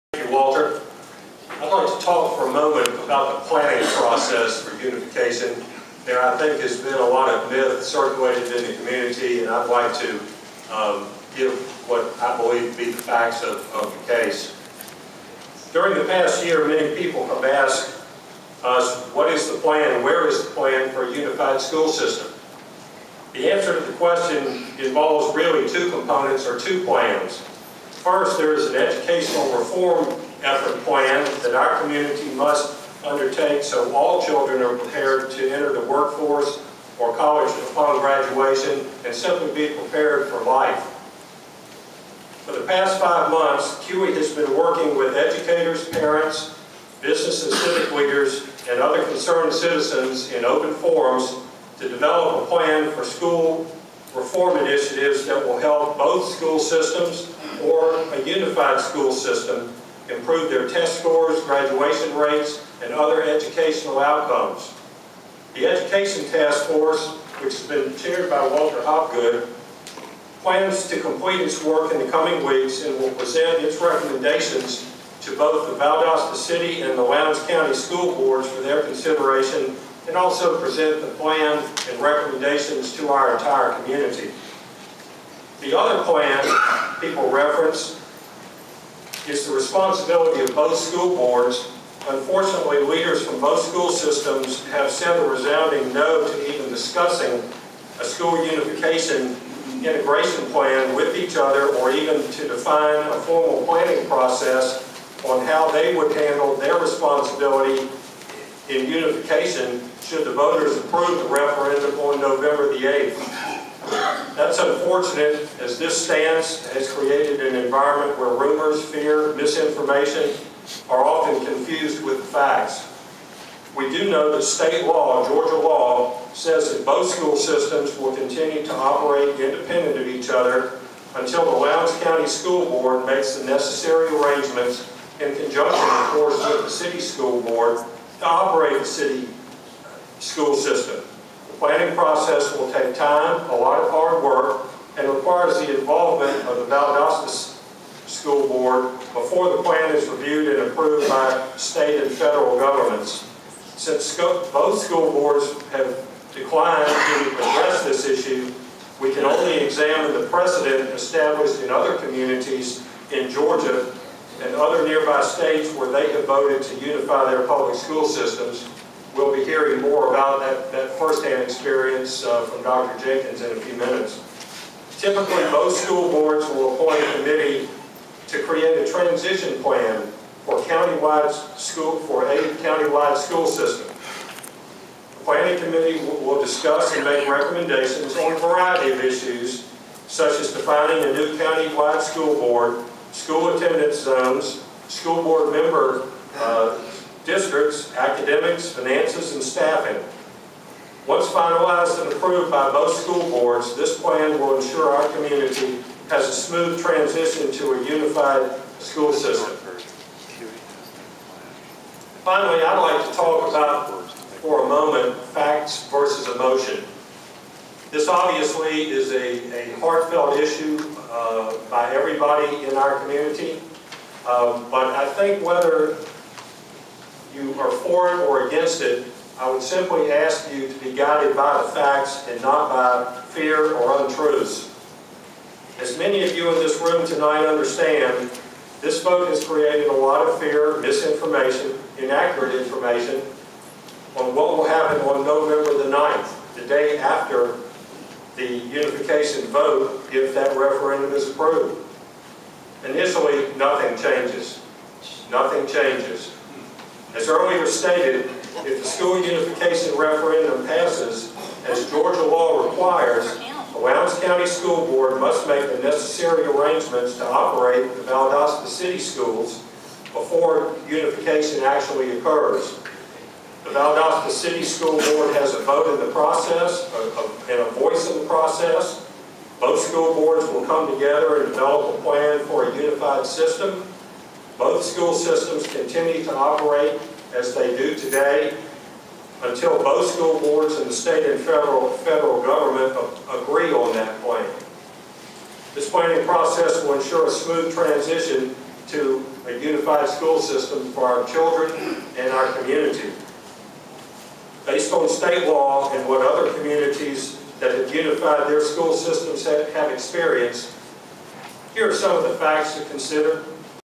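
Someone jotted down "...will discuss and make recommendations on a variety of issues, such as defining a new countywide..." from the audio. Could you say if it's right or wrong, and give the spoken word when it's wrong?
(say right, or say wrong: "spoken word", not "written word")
right.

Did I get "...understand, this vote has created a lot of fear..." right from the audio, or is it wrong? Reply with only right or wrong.
right.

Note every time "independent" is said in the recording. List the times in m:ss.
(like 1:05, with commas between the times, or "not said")
2:09.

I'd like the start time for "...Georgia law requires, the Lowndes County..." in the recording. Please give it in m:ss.
4:21.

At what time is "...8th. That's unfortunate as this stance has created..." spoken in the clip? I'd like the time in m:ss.
1:52.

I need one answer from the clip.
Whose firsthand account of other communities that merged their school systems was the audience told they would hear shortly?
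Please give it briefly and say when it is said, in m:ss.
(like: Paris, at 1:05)
Dr. Jenkins, at 2:52.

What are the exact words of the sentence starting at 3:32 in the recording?
Finally, I'd like to talk about, for a moment, facts versus emotion.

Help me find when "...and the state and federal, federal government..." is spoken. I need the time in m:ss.
4:50.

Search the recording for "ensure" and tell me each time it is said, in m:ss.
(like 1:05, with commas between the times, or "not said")
3:24, 4:56.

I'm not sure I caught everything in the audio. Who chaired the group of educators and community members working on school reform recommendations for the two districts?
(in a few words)
Walter Hopgood.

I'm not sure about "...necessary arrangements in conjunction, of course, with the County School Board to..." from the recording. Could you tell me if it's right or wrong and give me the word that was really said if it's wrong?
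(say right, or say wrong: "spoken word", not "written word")
wrong: "City", not "County".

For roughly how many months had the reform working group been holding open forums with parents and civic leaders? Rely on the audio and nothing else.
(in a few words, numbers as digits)
5.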